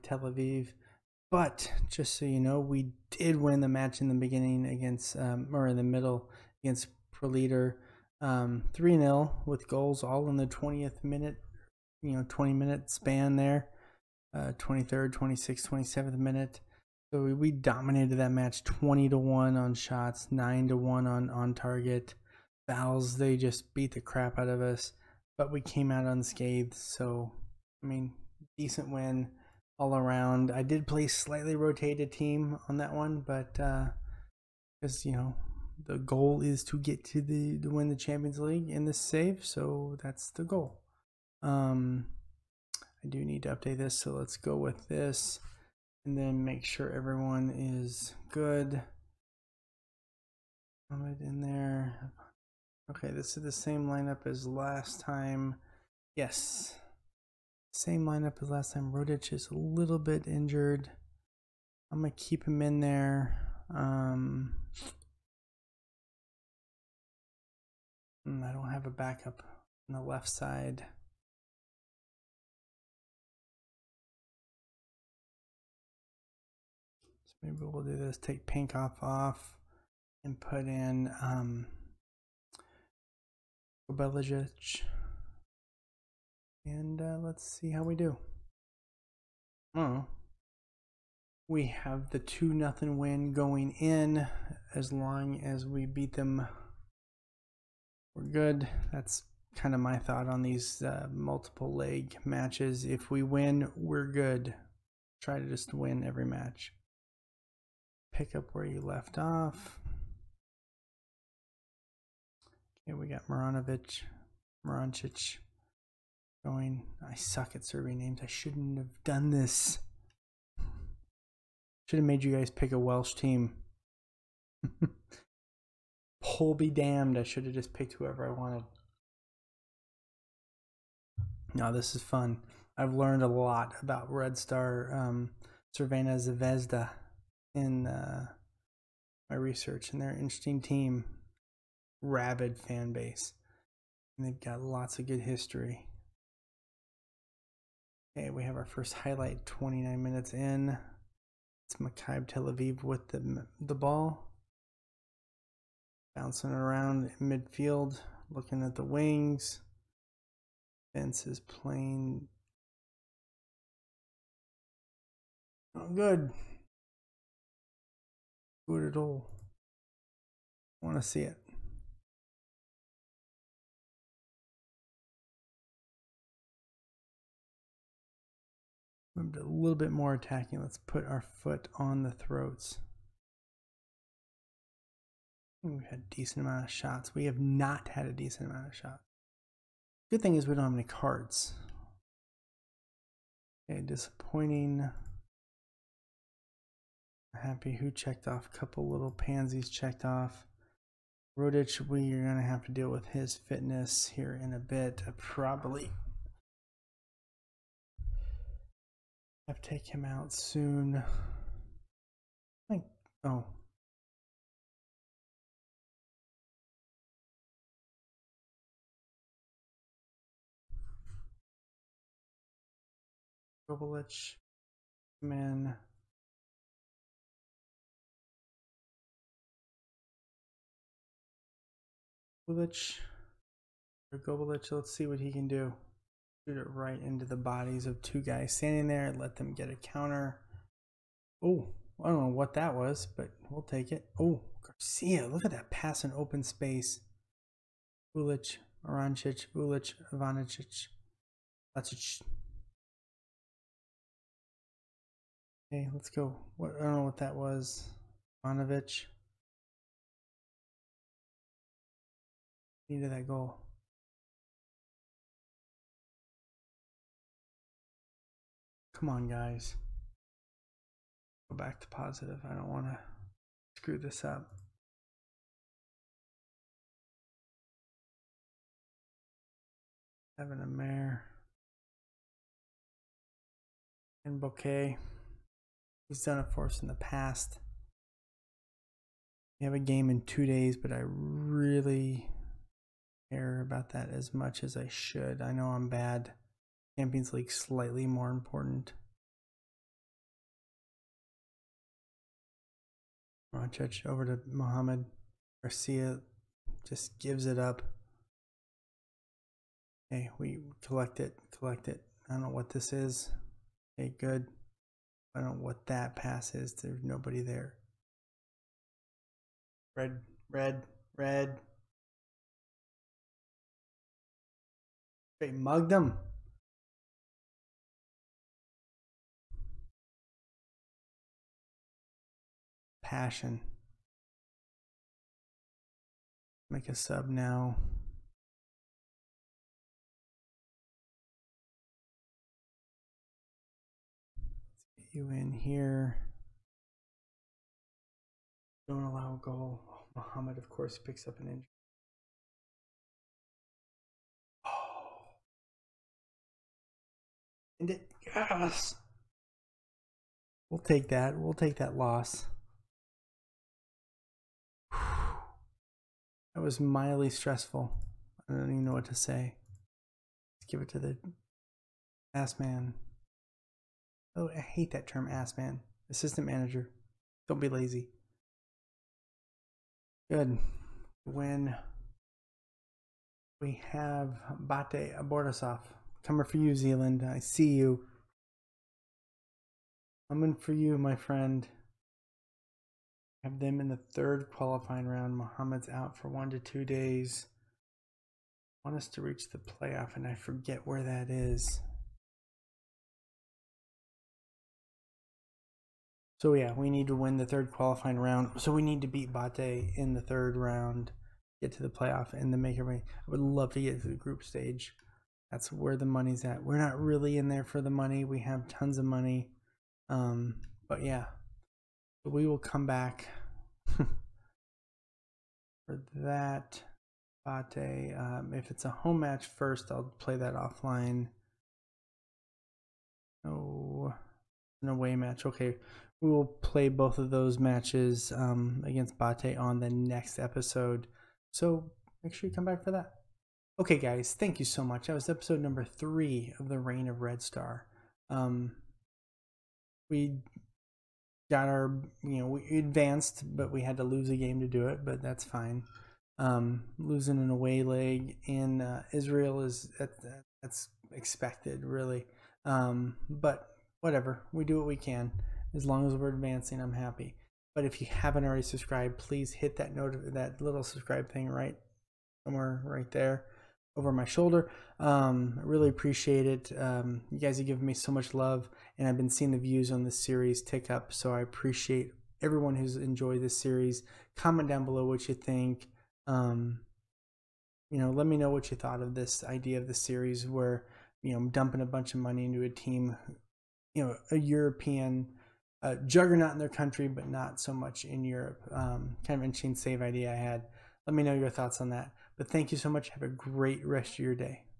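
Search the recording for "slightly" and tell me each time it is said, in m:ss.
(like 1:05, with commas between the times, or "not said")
0:31, 4:57.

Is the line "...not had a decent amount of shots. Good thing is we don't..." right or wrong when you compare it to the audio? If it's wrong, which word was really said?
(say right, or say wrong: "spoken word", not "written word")
right.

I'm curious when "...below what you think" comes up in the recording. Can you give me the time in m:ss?
8:04.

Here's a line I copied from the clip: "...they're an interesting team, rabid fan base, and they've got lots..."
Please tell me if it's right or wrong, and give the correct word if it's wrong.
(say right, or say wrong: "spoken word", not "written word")
right.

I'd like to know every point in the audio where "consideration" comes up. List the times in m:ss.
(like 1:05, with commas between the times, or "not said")
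not said.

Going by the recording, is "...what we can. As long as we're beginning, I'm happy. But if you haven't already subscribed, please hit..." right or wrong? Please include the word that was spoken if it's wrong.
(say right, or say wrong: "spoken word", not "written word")
wrong: "advancing", not "beginning".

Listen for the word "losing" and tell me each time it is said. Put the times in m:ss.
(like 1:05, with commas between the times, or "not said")
7:36.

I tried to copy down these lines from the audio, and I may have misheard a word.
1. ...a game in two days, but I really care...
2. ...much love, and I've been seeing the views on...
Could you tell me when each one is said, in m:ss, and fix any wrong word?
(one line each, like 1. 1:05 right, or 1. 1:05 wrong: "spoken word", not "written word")
1. 4:49 right
2. 7:58 right.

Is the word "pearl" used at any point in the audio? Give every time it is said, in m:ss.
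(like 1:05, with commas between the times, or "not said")
not said.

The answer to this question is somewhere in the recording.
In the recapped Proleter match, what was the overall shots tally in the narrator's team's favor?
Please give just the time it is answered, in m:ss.
0:18.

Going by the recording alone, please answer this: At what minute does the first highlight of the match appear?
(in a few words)
29.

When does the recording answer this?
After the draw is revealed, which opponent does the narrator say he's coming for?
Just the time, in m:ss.
6:26.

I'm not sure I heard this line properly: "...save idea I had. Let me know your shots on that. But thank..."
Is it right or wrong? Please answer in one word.
wrong.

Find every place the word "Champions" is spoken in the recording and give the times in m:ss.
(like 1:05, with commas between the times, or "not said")
0:37, 4:56.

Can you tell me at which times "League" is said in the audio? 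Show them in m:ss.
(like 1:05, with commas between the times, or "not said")
0:38, 4:57.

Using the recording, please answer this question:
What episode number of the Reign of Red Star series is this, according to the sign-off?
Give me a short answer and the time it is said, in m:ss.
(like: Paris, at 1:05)
3, at 7:25.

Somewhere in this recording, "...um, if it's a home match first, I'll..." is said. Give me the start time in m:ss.
7:08.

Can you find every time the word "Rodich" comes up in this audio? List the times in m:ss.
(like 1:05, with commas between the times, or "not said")
0:58, 3:21.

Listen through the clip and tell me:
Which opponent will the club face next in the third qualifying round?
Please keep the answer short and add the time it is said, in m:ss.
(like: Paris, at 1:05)
Bate Borisov, at 6:24.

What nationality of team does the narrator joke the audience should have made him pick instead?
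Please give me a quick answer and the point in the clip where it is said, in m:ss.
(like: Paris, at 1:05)
Welsh, at 2:02.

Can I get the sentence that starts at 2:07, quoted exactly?
I should have just picked whoever I wanted.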